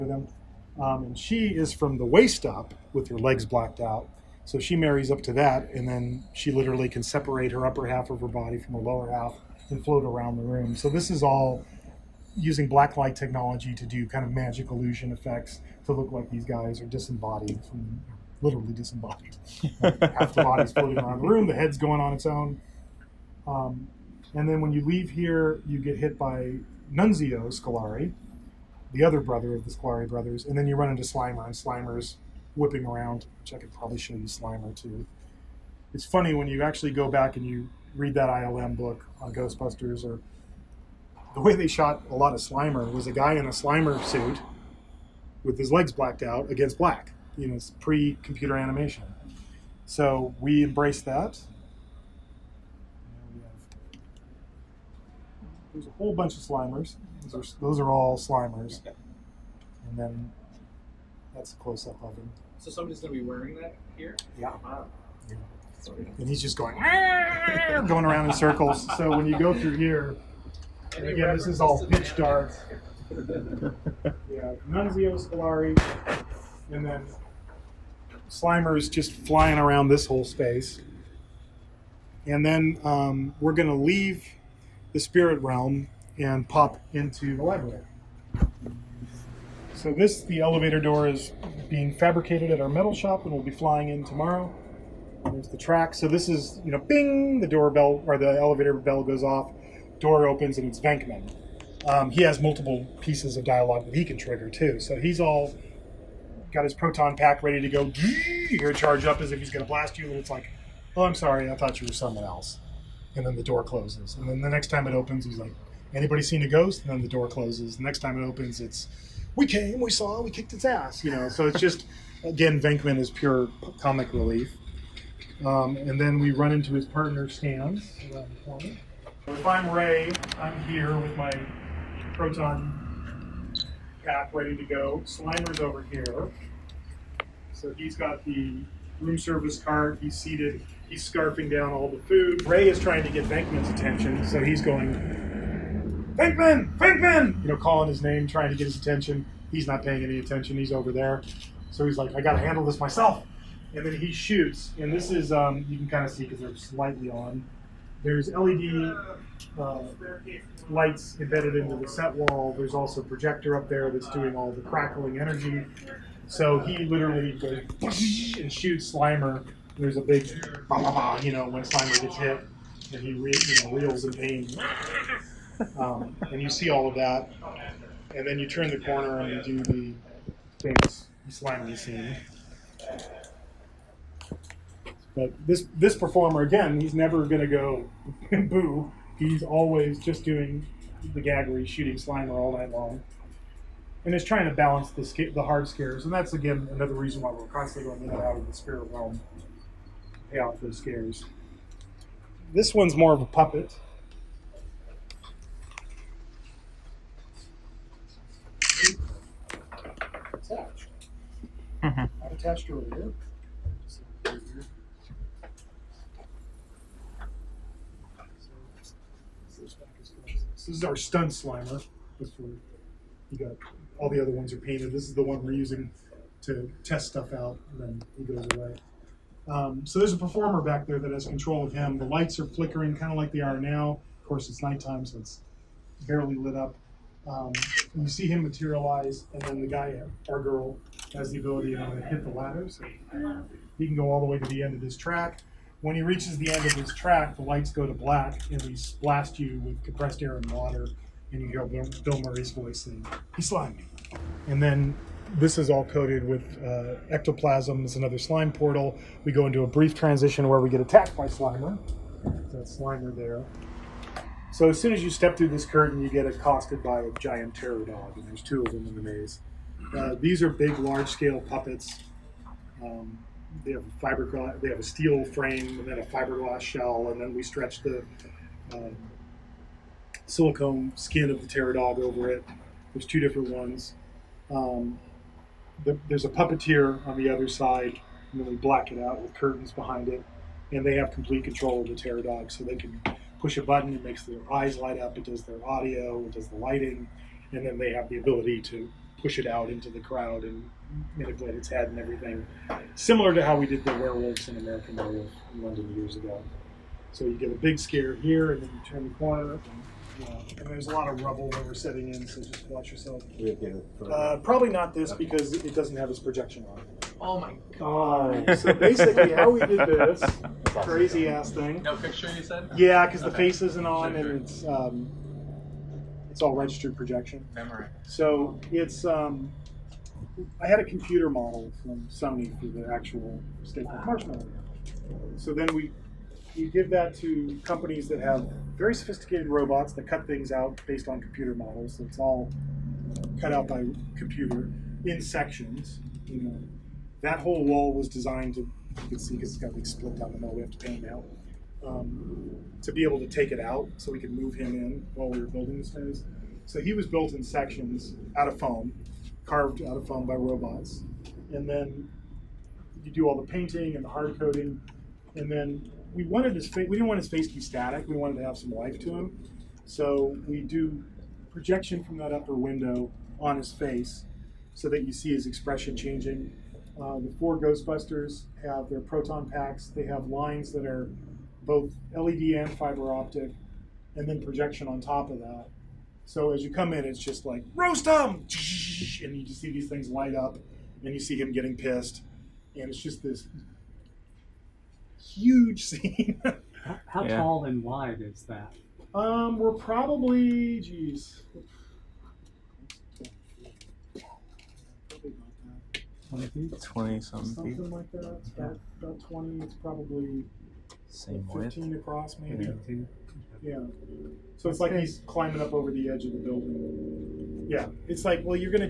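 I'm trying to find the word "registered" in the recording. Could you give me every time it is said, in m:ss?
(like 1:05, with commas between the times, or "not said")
5:26.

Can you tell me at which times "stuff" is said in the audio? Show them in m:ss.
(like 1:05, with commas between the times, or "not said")
3:47.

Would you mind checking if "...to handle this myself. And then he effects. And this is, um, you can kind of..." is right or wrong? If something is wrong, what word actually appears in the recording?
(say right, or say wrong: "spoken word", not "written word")
wrong: "shoots", not "effects".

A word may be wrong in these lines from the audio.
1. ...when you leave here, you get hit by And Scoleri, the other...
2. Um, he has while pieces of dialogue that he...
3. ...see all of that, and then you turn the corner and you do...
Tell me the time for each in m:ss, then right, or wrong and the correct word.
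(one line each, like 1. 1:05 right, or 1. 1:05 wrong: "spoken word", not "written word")
1. 0:24 wrong: "Nunzio", not "And"
2. 1:41 wrong: "multiple", not "while"
3. 2:56 right.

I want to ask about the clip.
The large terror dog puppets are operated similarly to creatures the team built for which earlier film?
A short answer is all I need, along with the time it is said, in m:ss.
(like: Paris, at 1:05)
American Werewolf in London, at 5:04.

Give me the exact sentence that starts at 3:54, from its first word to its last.
Of course, it's nighttime, so it's barely lit up.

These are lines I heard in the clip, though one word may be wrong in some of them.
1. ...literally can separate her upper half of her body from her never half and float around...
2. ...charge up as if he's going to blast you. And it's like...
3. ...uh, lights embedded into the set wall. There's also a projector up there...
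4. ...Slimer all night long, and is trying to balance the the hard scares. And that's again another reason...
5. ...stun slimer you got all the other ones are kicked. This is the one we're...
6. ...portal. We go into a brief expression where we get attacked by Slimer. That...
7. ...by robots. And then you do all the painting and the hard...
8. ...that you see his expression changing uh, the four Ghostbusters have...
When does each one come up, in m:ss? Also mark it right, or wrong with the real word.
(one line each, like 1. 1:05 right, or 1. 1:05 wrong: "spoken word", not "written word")
1. 0:06 wrong: "lower", not "never"
2. 1:48 right
3. 2:39 right
4. 3:11 right
5. 3:40 wrong: "painted", not "kicked"
6. 4:18 wrong: "transition", not "expression"
7. 6:00 right
8. 6:14 right.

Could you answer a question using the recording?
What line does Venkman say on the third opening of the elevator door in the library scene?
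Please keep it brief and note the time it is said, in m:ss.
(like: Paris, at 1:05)
We came, we saw, we kicked its ass, at 1:59.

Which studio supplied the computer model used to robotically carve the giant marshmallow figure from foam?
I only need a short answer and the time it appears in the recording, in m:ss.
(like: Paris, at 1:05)
Sony, at 5:32.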